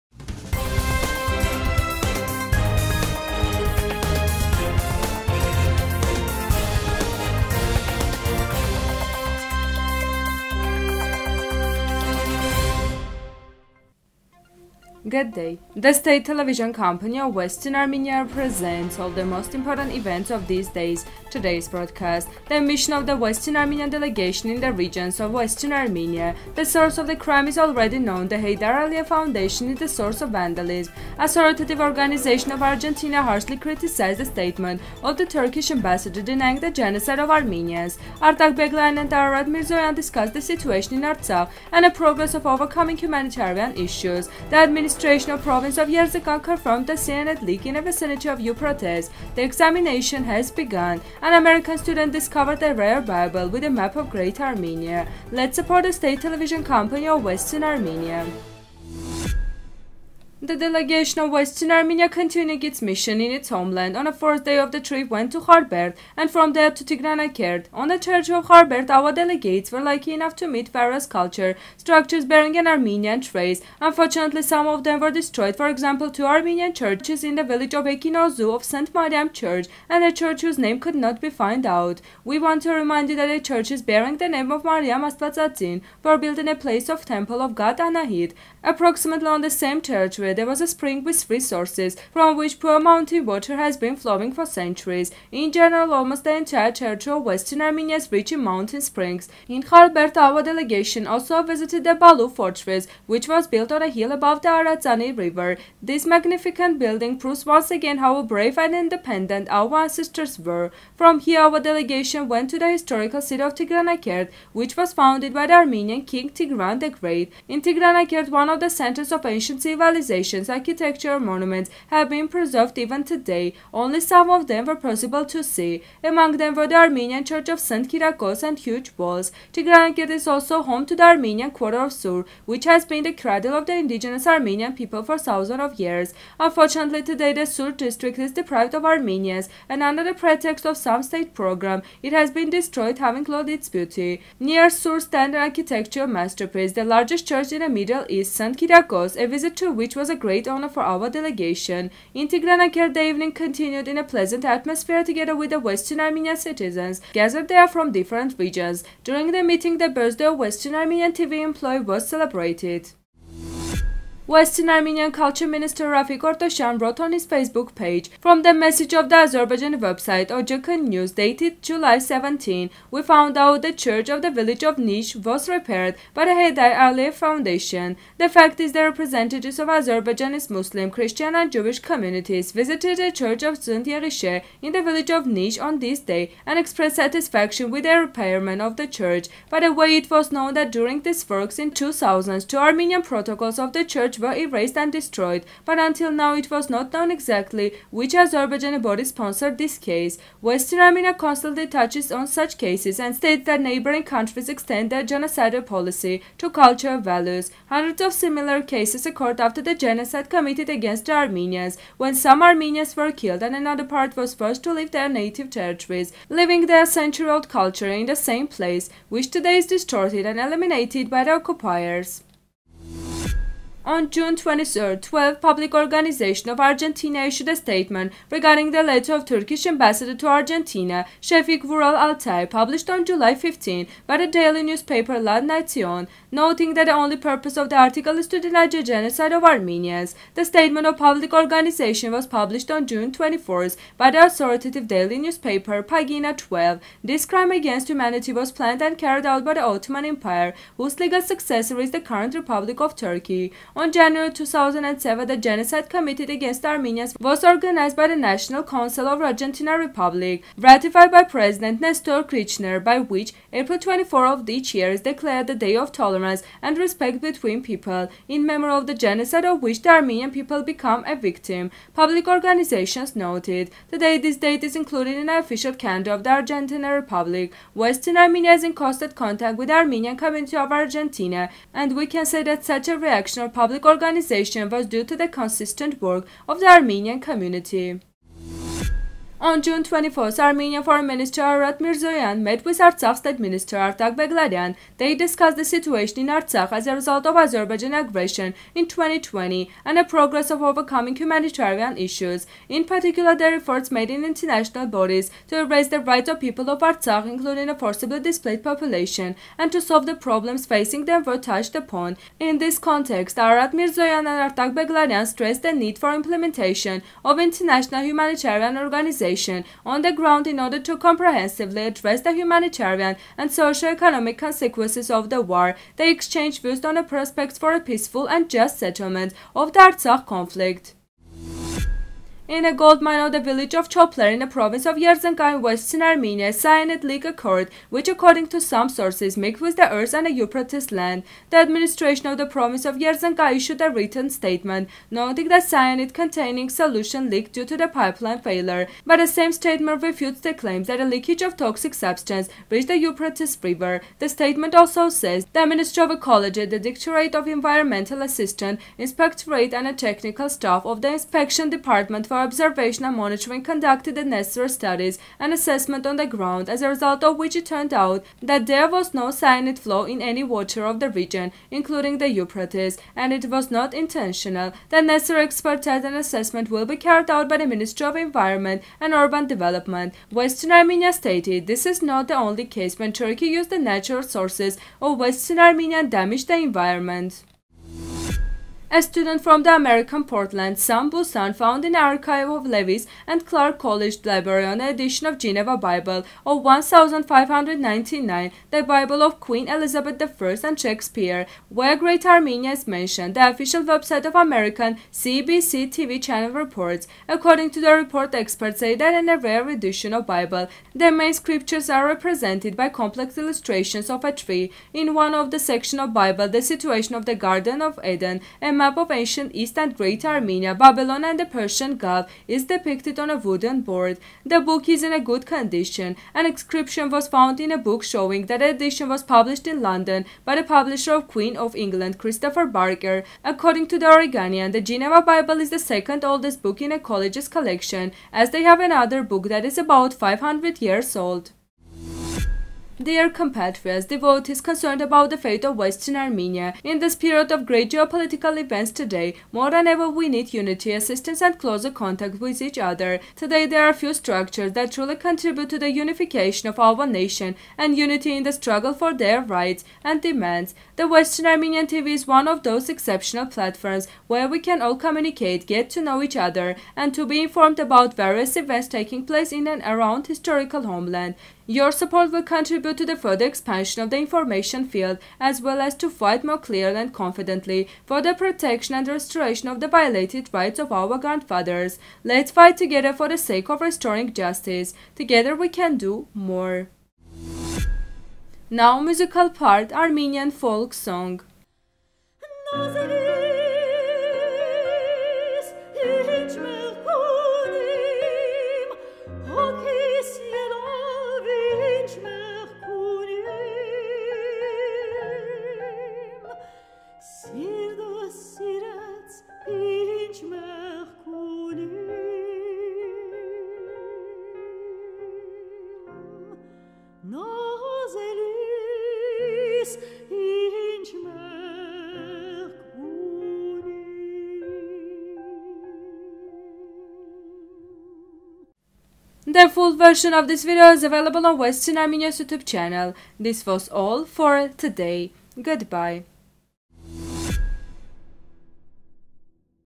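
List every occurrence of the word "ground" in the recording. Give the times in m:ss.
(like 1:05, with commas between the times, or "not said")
5:20, 6:06.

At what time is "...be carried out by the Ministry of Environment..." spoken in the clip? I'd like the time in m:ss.
6:16.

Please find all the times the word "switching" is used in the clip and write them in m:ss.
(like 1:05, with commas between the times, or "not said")
not said.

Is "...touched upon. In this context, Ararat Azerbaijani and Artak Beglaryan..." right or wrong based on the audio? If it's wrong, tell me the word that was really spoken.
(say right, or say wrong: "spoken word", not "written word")
wrong: "Mirzoyan", not "Azerbaijani".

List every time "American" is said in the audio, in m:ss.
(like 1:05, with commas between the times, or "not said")
0:51, 6:29, 6:44.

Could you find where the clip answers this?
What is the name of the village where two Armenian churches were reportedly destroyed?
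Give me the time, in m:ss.
1:17.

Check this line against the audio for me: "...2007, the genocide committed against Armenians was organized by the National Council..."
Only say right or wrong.
right.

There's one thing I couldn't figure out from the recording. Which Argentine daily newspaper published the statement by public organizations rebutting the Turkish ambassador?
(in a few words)
Pagina 12.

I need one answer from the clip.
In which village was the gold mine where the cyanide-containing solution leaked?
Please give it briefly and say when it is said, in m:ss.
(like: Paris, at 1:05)
Chopler, at 5:33.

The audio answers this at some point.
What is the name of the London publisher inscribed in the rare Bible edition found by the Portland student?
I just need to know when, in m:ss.
7:12.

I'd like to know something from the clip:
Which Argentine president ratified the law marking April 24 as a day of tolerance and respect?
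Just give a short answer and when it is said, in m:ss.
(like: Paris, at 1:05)
Nestor Kirchner, at 4:21.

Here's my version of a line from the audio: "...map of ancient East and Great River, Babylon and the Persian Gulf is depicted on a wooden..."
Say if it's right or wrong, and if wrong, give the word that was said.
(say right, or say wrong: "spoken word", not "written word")
wrong: "Armenia", not "River".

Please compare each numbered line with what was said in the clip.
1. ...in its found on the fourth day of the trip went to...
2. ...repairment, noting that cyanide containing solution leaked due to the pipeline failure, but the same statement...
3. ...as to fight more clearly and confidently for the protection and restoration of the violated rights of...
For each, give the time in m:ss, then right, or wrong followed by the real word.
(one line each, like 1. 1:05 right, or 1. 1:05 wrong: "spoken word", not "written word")
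1. 1:03 wrong: "homeland", not "found"
2. 5:44 wrong: "statement", not "repairment"
3. 7:55 right.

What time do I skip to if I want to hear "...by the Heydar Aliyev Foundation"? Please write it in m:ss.
2:56.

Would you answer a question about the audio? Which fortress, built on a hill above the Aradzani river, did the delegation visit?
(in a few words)
Balu fortress.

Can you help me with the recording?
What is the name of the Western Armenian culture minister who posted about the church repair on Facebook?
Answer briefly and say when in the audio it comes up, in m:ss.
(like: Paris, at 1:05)
Rafik Ortoshan, at 2:45.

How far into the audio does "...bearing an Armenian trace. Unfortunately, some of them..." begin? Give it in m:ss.
1:12.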